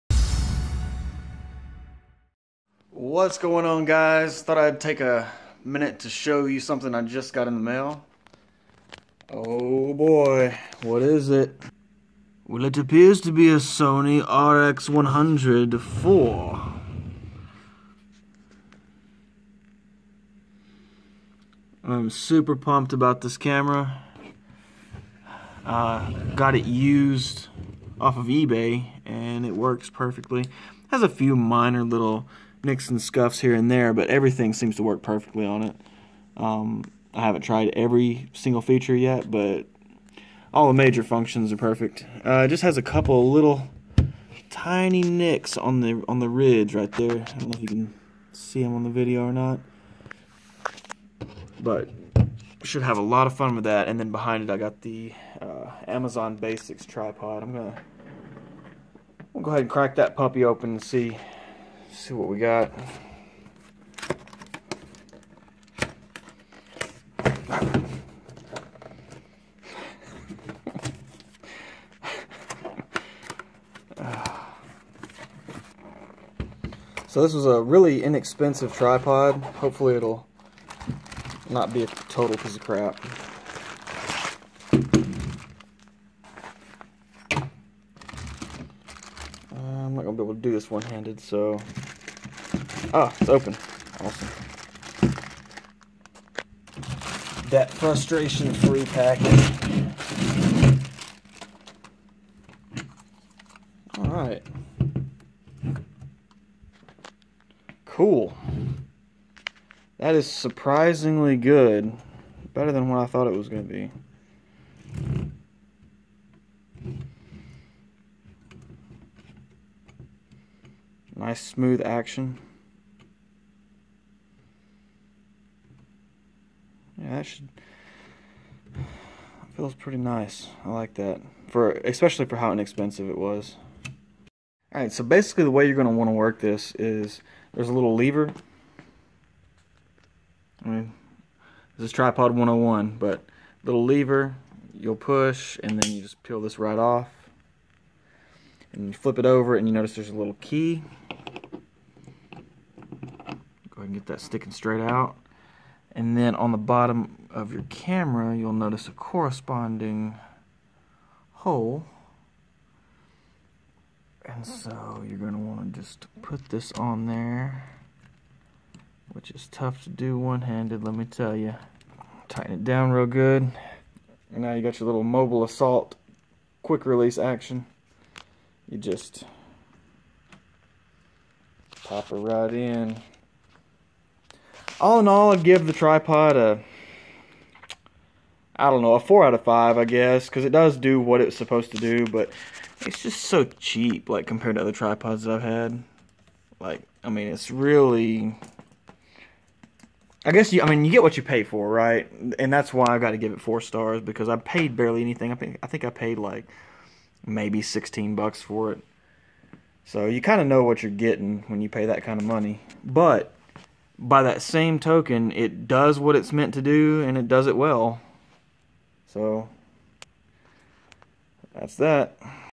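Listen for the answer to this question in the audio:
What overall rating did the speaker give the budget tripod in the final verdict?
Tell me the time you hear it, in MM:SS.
03:08.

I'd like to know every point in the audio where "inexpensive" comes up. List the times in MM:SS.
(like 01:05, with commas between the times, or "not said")
01:18, 02:12.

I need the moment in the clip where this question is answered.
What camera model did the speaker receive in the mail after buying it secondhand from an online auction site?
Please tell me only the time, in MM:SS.
00:13.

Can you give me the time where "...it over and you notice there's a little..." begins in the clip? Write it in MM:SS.
02:29.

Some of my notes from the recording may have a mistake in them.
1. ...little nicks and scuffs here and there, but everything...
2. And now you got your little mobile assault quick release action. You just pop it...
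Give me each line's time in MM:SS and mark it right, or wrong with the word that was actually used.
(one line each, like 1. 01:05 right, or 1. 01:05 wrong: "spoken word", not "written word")
1. 00:31 right
2. 02:54 right.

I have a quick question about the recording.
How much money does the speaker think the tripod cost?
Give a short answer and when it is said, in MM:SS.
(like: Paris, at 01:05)
$16, at 03:27.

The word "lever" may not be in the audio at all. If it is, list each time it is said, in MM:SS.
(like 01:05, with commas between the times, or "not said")
02:17, 02:23.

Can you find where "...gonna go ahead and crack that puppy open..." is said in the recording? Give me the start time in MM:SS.
00:59.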